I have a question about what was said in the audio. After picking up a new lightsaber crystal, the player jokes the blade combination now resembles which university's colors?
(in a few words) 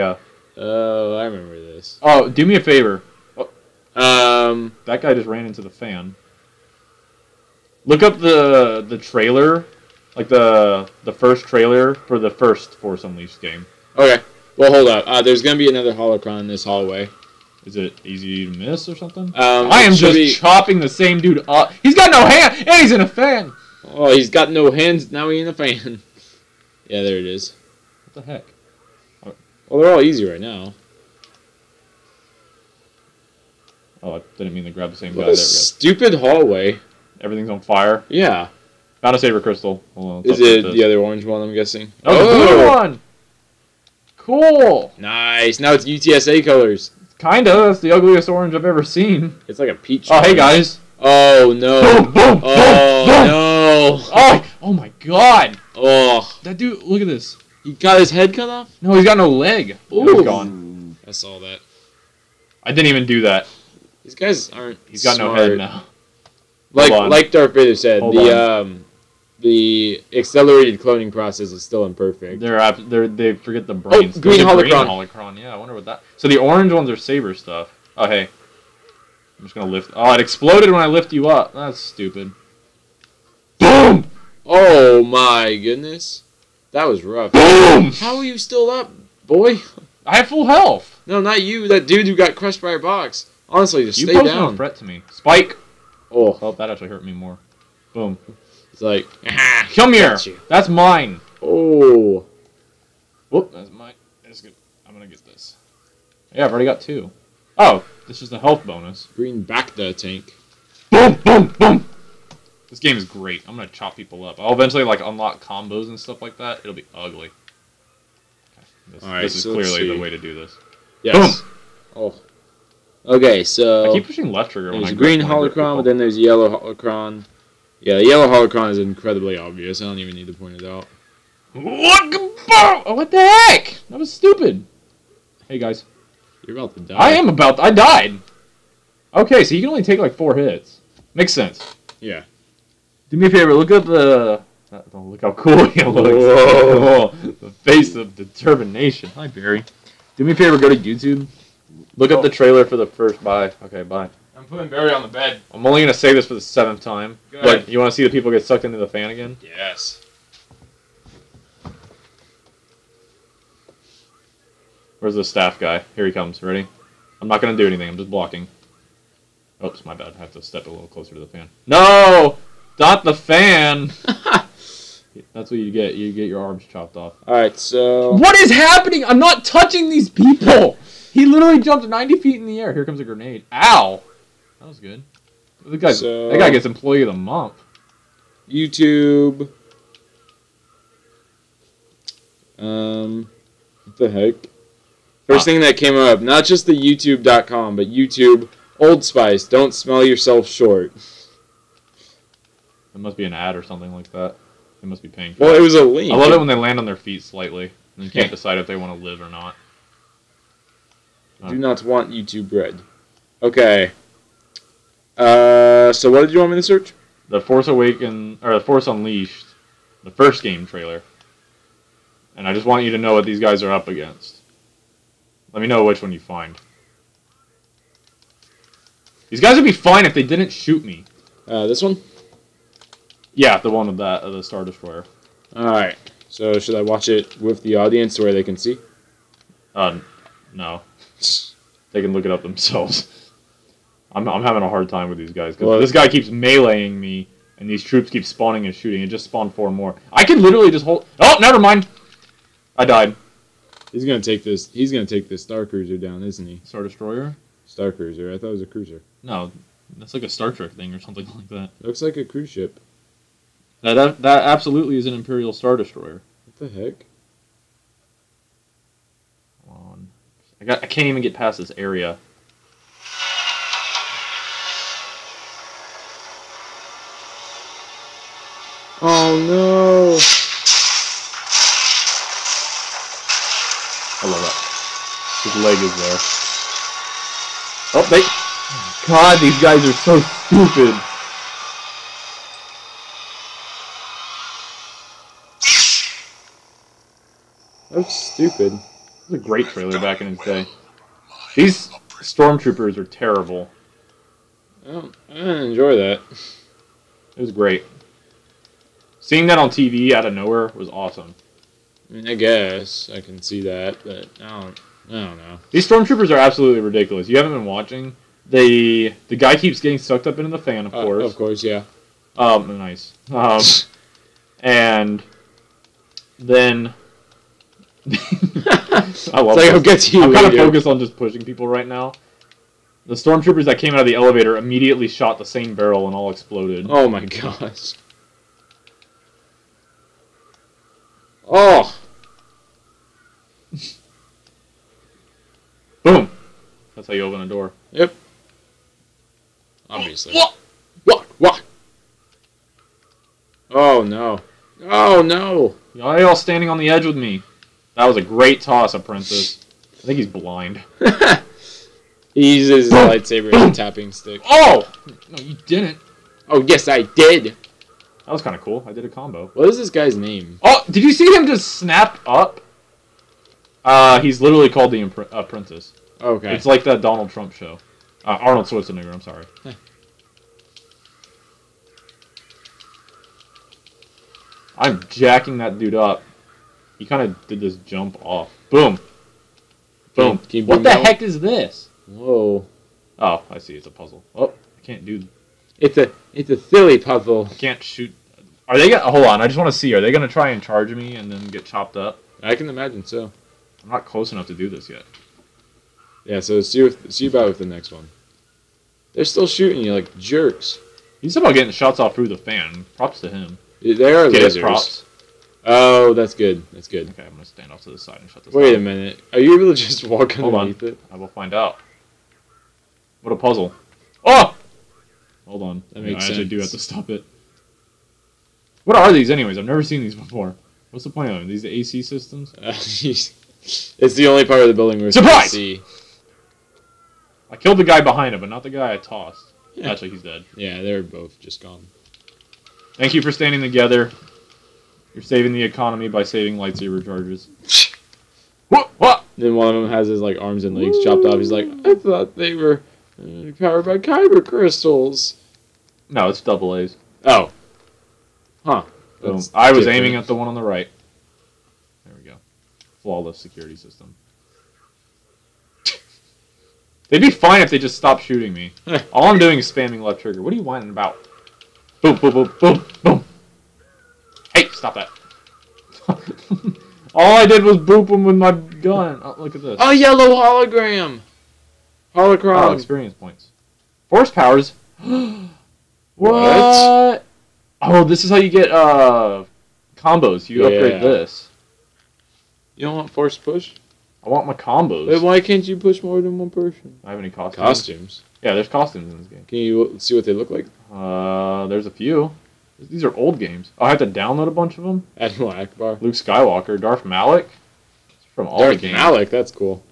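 UTSA.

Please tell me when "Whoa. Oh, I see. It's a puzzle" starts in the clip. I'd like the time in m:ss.
6:32.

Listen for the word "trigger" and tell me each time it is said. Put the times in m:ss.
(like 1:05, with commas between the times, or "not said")
2:04, 7:50.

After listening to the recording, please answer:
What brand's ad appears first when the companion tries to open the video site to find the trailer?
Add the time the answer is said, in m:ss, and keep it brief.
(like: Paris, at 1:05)
Old Spice, at 3:18.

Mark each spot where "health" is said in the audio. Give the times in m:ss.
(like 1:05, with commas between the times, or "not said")
1:30, 1:48.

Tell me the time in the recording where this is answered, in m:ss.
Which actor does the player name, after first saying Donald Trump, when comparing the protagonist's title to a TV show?
6:18.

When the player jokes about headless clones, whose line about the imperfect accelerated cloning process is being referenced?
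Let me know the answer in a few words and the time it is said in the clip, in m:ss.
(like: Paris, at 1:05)
Darth Vader, at 1:07.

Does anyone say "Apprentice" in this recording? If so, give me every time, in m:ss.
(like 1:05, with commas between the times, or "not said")
5:58, 6:15.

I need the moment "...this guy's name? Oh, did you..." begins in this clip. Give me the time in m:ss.
6:09.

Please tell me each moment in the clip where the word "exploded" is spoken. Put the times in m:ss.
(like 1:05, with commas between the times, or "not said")
1:20, 5:36.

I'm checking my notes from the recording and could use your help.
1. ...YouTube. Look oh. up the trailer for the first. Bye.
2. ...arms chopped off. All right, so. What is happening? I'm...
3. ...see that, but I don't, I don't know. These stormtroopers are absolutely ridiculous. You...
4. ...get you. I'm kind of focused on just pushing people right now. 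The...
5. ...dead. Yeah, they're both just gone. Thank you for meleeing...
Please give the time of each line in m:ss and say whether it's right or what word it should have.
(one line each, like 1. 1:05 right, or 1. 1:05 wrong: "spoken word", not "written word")
1. 2:30 right
2. 2:56 right
3. 5:13 right
4. 5:29 right
5. 7:20 wrong: "standing", not "meleeing".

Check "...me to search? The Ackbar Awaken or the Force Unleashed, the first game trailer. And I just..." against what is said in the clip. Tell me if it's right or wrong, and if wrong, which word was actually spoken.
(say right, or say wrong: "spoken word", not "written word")
wrong: "Force", not "Ackbar".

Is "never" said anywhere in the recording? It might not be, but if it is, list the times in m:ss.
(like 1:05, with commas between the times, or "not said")
4:11, 7:09.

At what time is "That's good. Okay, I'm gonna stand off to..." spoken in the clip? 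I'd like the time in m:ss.
6:56.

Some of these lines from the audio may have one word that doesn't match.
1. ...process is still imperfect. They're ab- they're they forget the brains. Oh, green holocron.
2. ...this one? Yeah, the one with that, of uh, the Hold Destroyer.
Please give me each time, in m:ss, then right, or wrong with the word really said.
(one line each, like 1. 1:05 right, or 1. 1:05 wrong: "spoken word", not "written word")
1. 1:11 right
2. 3:51 wrong: "Star", not "Hold".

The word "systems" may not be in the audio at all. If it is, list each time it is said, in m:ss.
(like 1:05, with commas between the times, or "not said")
7:12, 7:43.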